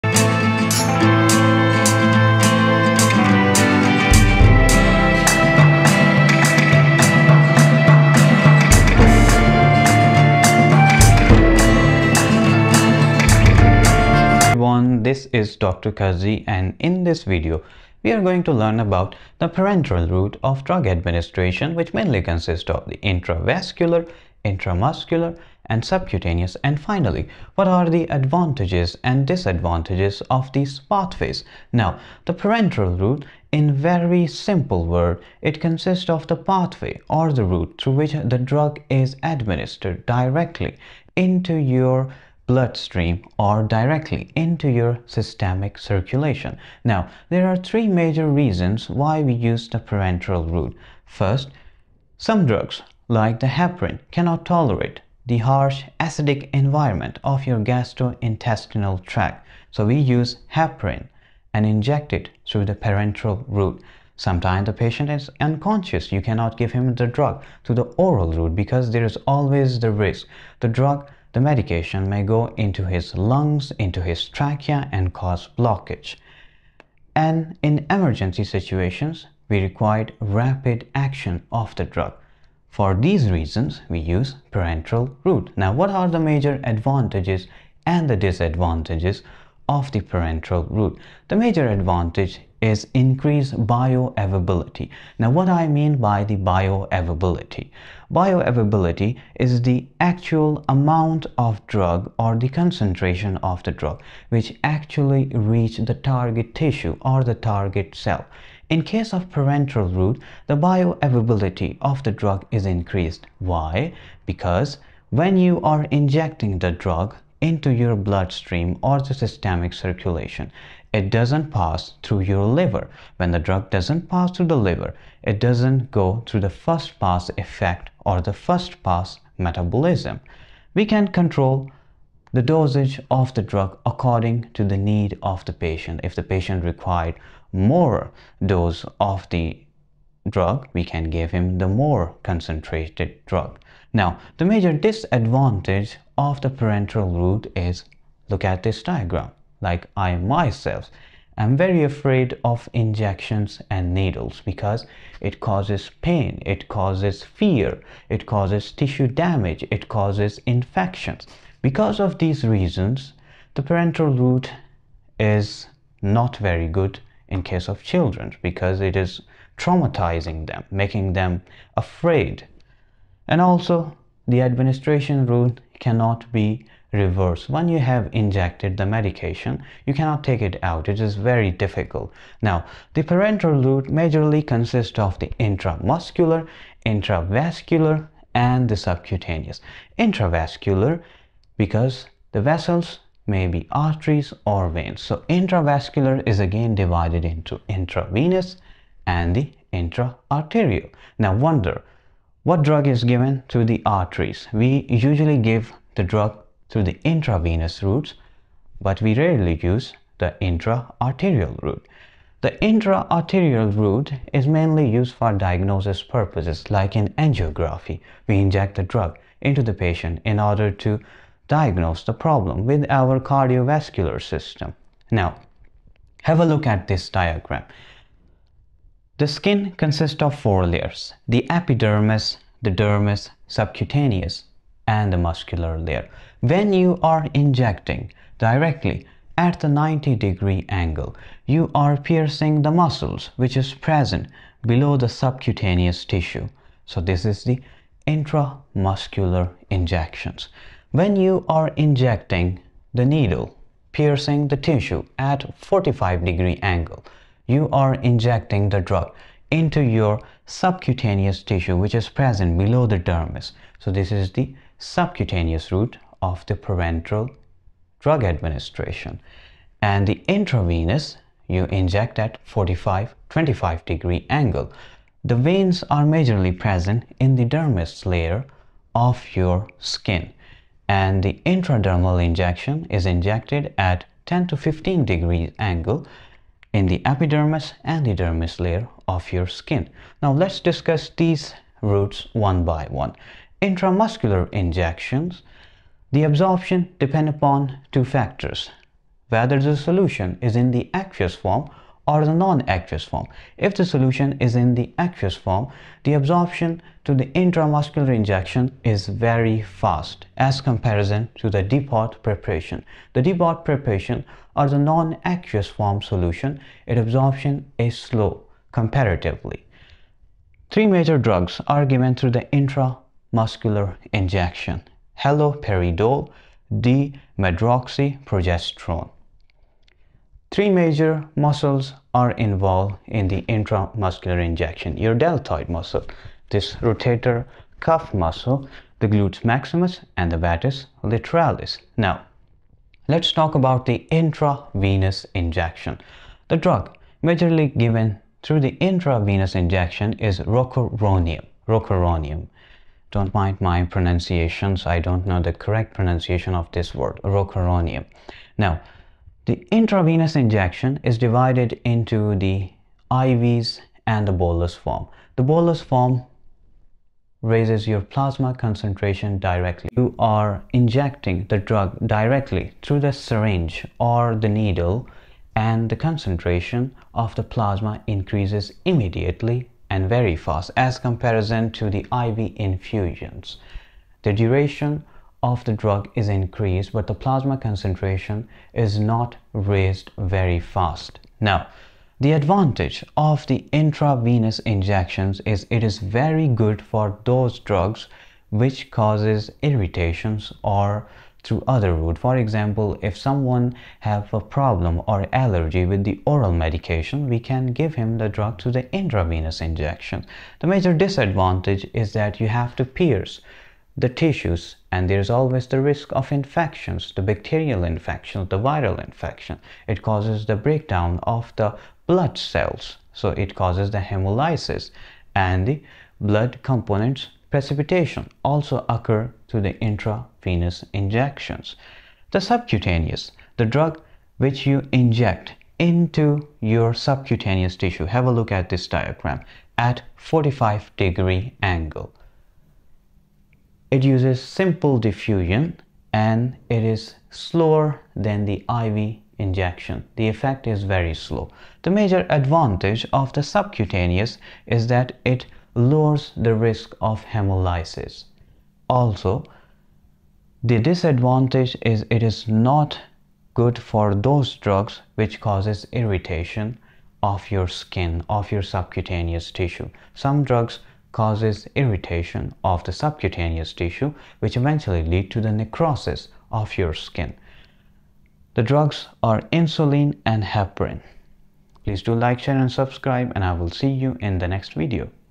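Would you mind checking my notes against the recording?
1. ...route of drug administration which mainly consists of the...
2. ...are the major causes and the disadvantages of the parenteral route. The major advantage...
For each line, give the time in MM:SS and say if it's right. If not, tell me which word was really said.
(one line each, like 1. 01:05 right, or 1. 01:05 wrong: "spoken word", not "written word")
1. 00:20 right
2. 01:25 wrong: "advantages", not "causes".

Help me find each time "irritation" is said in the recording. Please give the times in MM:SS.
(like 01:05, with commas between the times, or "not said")
06:39, 07:45, 07:51.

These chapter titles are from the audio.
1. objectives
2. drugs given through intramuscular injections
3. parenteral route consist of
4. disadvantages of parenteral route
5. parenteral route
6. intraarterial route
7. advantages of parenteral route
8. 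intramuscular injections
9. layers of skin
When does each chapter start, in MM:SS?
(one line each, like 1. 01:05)
1. 00:12
2. 05:22
3. 03:05
4. 02:25
5. 00:32
6. 03:26
7. 01:27
8. 04:55
9. 03:50.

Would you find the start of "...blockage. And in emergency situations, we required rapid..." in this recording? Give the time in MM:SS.
01:15.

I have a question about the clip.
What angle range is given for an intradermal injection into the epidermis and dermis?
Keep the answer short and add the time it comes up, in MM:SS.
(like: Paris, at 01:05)
10 to 15 degrees, at 04:44.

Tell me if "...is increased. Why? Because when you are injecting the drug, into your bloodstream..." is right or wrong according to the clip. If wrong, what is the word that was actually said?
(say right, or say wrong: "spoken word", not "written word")
right.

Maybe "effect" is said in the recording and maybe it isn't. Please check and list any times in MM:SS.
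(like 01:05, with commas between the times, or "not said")
02:07, 07:30.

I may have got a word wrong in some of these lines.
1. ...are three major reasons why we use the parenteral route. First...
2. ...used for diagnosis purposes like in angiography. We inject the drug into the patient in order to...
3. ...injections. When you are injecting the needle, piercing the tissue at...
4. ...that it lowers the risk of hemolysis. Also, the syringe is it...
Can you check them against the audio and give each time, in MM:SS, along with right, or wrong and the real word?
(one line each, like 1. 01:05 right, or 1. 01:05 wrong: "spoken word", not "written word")
1. 00:47 right
2. 03:34 right
3. 04:09 right
4. 07:34 wrong: "disadvantage", not "syringe".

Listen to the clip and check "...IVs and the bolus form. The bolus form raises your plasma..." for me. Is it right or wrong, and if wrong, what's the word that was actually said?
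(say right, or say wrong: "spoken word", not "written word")
right.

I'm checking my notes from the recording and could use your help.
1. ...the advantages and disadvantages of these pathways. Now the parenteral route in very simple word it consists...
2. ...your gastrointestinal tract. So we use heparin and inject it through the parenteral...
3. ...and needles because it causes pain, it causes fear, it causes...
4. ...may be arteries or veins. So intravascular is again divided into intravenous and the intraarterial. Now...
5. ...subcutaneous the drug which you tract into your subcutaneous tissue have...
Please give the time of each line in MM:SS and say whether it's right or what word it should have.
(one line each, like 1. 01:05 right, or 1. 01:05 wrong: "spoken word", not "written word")
1. 00:27 right
2. 00:57 right
3. 02:33 right
4. 03:13 right
5. 07:12 wrong: "inject", not "tract".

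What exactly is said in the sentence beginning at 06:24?
The duration of the drug is increased, but the plasma concentration is not raised very fast.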